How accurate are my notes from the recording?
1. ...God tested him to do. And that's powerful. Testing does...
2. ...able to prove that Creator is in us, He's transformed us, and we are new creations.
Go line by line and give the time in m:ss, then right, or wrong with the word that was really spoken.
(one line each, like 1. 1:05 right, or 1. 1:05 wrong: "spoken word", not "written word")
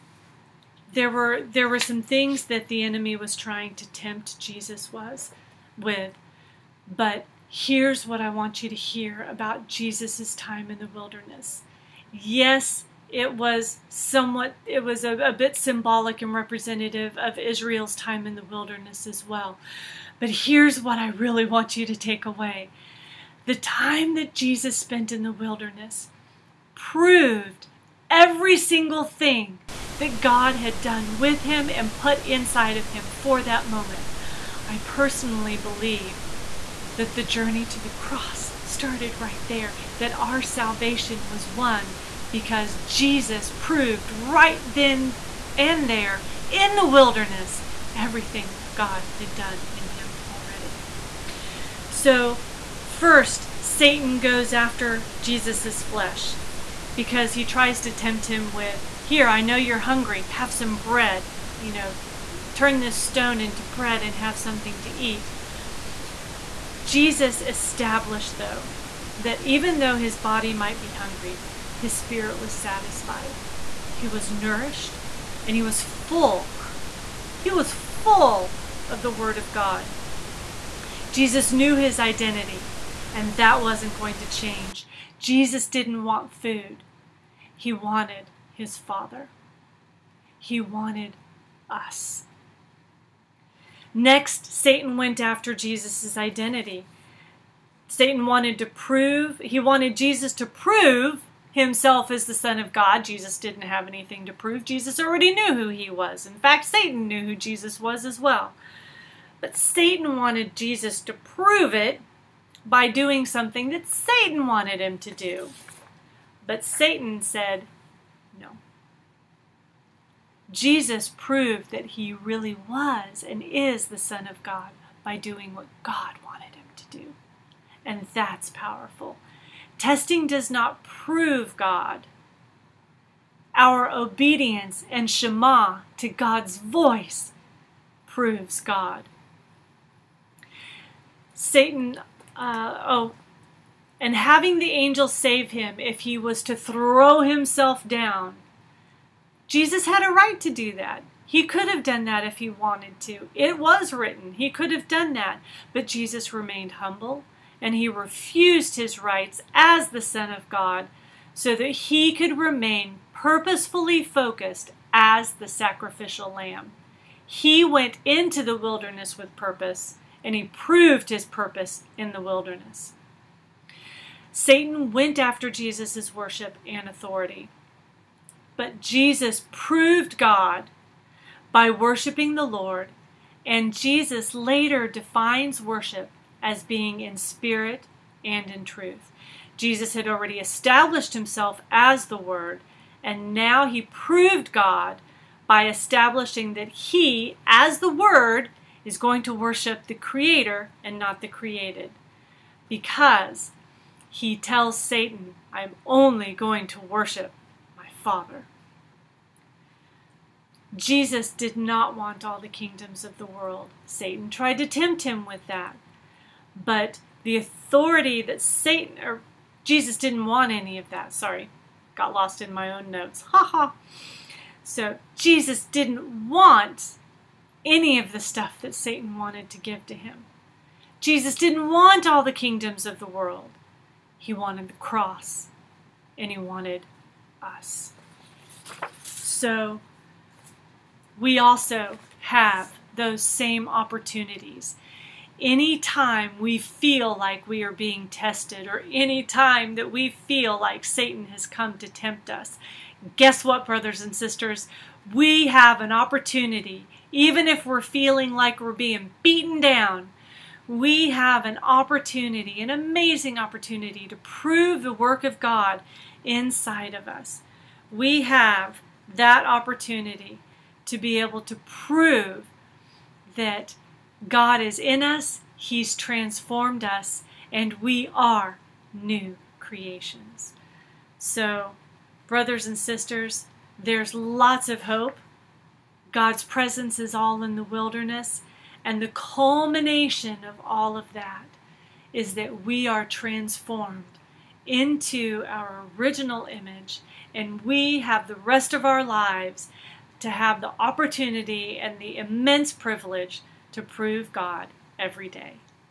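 1. 2:05 wrong: "wanted", not "tested"
2. 4:31 wrong: "God", not "Creator".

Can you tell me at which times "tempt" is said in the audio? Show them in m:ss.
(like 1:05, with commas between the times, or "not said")
0:03, 0:57, 3:34, 4:11.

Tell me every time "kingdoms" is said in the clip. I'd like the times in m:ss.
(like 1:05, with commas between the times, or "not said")
3:32, 3:52.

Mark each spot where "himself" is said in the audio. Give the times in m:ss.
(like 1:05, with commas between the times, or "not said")
1:41, 2:27, 3:11.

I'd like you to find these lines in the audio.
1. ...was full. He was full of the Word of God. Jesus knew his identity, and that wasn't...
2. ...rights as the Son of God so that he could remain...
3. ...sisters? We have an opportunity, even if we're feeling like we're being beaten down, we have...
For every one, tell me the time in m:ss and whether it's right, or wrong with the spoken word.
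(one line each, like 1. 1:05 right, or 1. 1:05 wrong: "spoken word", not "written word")
1. 1:15 right
2. 2:39 right
3. 4:14 right.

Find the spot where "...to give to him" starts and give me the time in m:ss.
3:49.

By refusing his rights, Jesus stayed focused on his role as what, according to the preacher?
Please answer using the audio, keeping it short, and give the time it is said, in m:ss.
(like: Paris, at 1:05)
The sacrificial lamb, at 2:45.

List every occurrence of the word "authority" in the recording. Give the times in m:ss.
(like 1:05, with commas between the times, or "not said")
2:56, 3:37.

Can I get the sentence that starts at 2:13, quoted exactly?
Our obedience and Shema to God's voice proves God.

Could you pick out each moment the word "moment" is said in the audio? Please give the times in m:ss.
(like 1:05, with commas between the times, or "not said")
0:33.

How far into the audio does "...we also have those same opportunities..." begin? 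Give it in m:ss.
4:01.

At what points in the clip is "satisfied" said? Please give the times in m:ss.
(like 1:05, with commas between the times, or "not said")
1:12.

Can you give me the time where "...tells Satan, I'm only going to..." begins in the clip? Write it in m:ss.
3:24.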